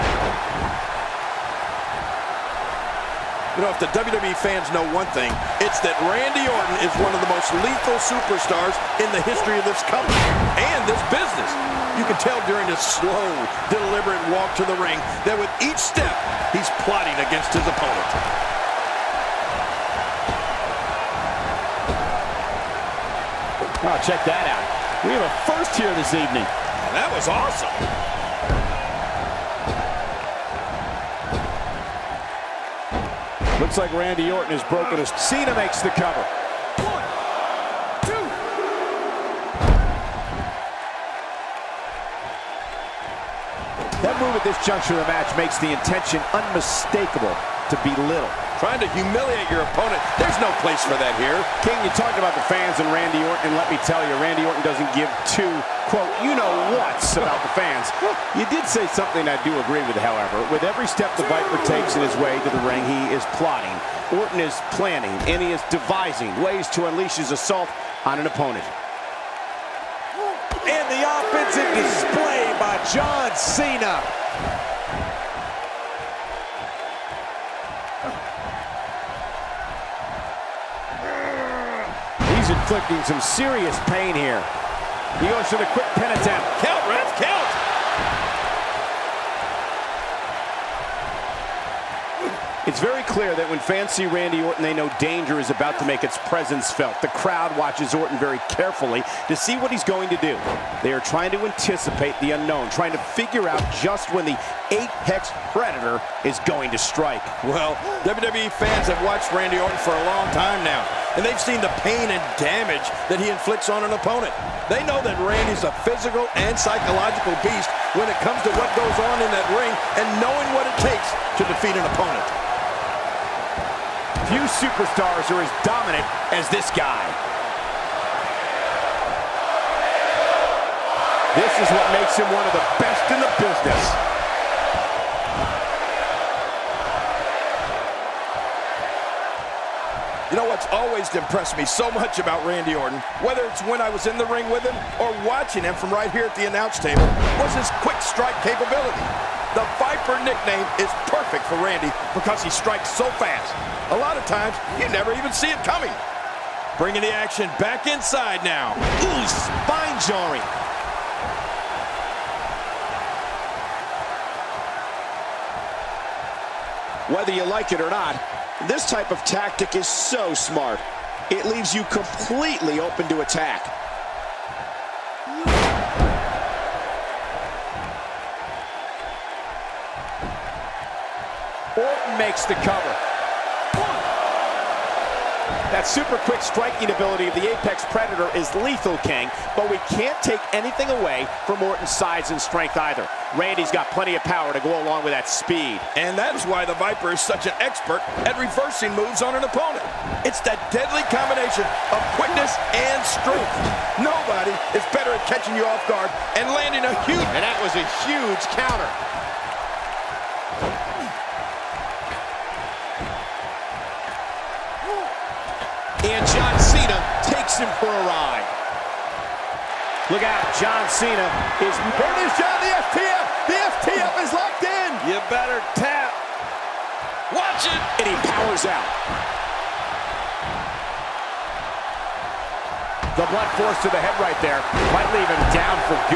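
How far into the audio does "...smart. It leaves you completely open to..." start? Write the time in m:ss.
2:50.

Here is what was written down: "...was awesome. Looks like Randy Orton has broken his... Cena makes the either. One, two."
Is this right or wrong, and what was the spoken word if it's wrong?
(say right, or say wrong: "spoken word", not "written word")
wrong: "cover", not "either".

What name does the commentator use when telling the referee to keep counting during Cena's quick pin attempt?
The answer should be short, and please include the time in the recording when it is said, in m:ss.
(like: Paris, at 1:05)
Reds, at 1:26.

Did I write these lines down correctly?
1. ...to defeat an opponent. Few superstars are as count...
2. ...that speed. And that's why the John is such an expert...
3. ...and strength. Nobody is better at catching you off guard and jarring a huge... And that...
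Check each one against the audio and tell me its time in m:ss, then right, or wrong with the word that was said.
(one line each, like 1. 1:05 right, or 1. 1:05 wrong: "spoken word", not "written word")
1. 2:01 wrong: "dominant", not "count"
2. 3:15 wrong: "Viper", not "John"
3. 3:22 wrong: "landing", not "jarring".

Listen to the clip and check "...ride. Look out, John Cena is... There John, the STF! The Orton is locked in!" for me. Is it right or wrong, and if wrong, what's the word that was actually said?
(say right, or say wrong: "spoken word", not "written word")
wrong: "STF", not "Orton".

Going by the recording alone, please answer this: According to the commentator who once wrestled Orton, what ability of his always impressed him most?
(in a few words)
Quick strike capability.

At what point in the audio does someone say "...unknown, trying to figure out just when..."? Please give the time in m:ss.
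1:42.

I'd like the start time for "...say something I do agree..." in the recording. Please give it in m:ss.
0:58.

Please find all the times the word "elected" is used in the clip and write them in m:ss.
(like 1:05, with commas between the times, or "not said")
not said.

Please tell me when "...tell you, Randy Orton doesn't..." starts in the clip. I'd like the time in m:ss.
0:53.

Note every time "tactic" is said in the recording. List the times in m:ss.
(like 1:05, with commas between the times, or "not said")
2:49.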